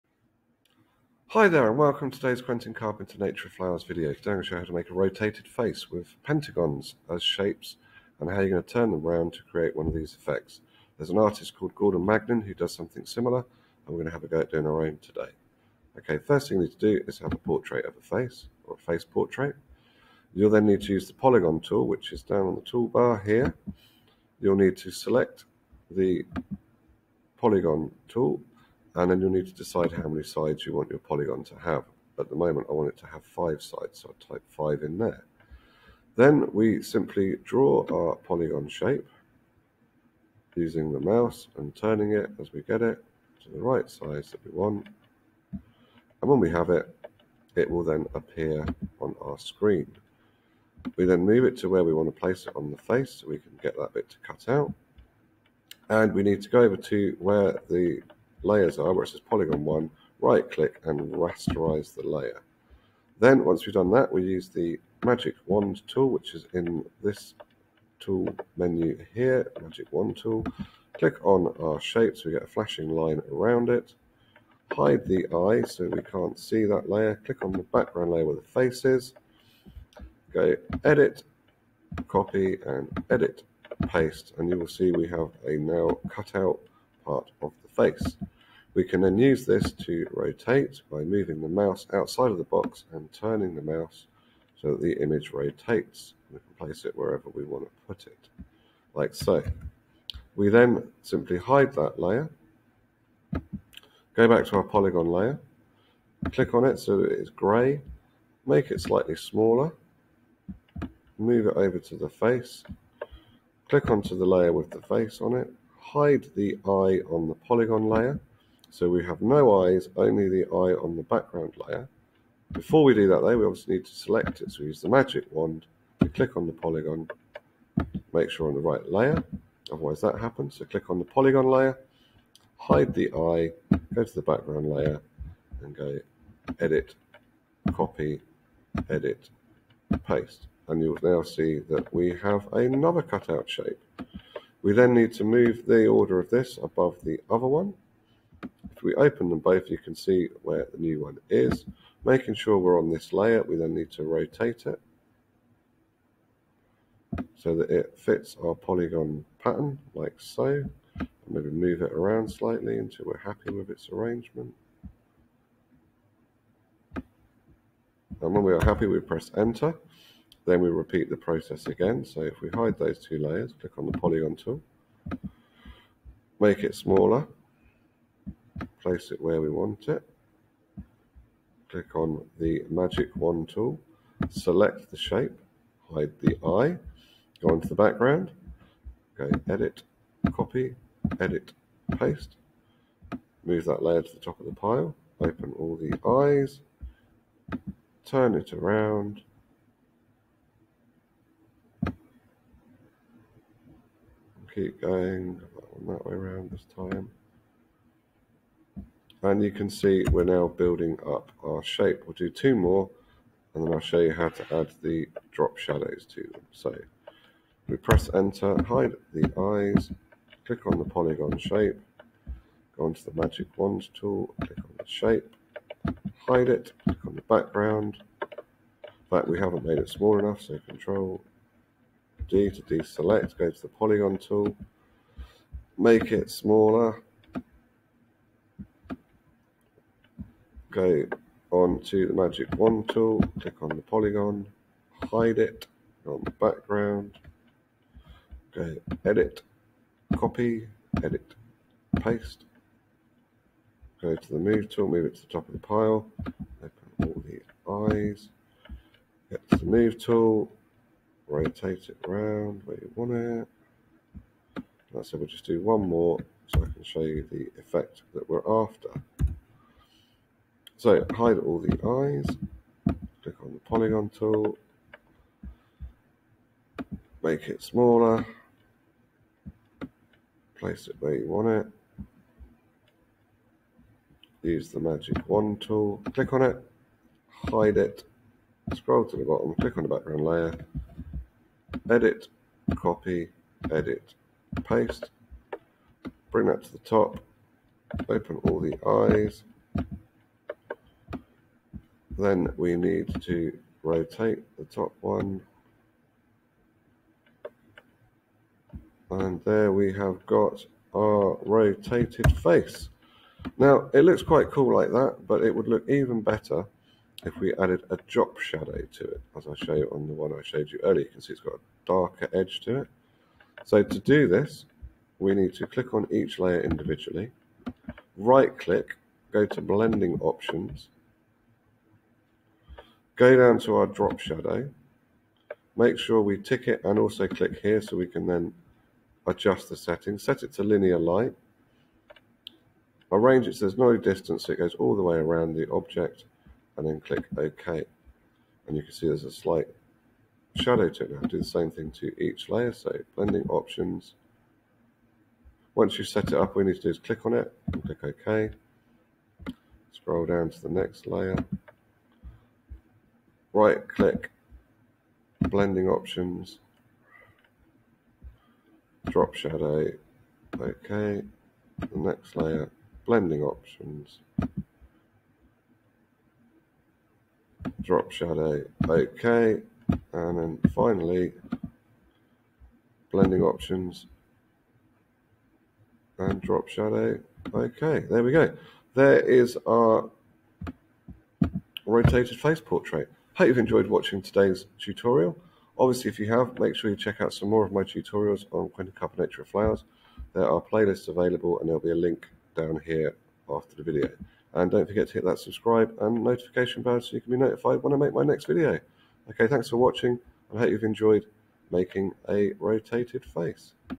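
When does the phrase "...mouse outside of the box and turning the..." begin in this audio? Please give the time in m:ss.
1:31.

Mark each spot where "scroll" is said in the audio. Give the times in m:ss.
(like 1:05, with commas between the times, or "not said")
4:48, 5:59.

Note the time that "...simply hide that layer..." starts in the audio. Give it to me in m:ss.
1:41.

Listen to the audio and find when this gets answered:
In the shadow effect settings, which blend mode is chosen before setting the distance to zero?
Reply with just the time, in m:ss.
5:40.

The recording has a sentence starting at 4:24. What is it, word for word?
Like I said, we'll just do one more so I can show you the effect that we're after.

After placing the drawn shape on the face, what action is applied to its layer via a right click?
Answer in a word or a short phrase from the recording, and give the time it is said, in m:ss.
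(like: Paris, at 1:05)
Rasterize, at 1:01.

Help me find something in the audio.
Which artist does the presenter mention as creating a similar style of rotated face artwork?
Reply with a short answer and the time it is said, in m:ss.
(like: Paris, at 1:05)
Gordon Magnin, at 0:11.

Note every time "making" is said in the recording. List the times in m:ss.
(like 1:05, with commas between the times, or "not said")
2:32, 6:51.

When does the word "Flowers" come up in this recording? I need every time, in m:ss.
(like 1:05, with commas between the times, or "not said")
0:03, 6:39.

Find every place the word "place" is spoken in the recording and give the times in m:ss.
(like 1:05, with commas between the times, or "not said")
0:52, 1:36, 2:58, 4:40.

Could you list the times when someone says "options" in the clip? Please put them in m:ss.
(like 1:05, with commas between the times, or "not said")
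5:30, 5:53, 6:05, 6:13, 6:23.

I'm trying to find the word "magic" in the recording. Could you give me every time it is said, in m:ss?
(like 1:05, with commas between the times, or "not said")
1:05, 1:09, 2:04, 3:02, 3:43, 4:02, 4:44.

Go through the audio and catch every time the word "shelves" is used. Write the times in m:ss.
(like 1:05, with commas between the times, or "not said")
not said.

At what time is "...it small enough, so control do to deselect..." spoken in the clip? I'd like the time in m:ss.
3:49.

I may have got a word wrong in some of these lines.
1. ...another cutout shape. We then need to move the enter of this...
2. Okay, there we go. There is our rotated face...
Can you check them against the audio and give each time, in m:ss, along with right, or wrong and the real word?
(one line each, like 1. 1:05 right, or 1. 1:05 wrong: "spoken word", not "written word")
1. 2:22 wrong: "order", not "enter"
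2. 6:27 right.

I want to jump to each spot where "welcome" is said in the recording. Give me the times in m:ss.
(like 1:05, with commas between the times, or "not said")
0:01.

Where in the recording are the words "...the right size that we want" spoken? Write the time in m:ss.
0:43.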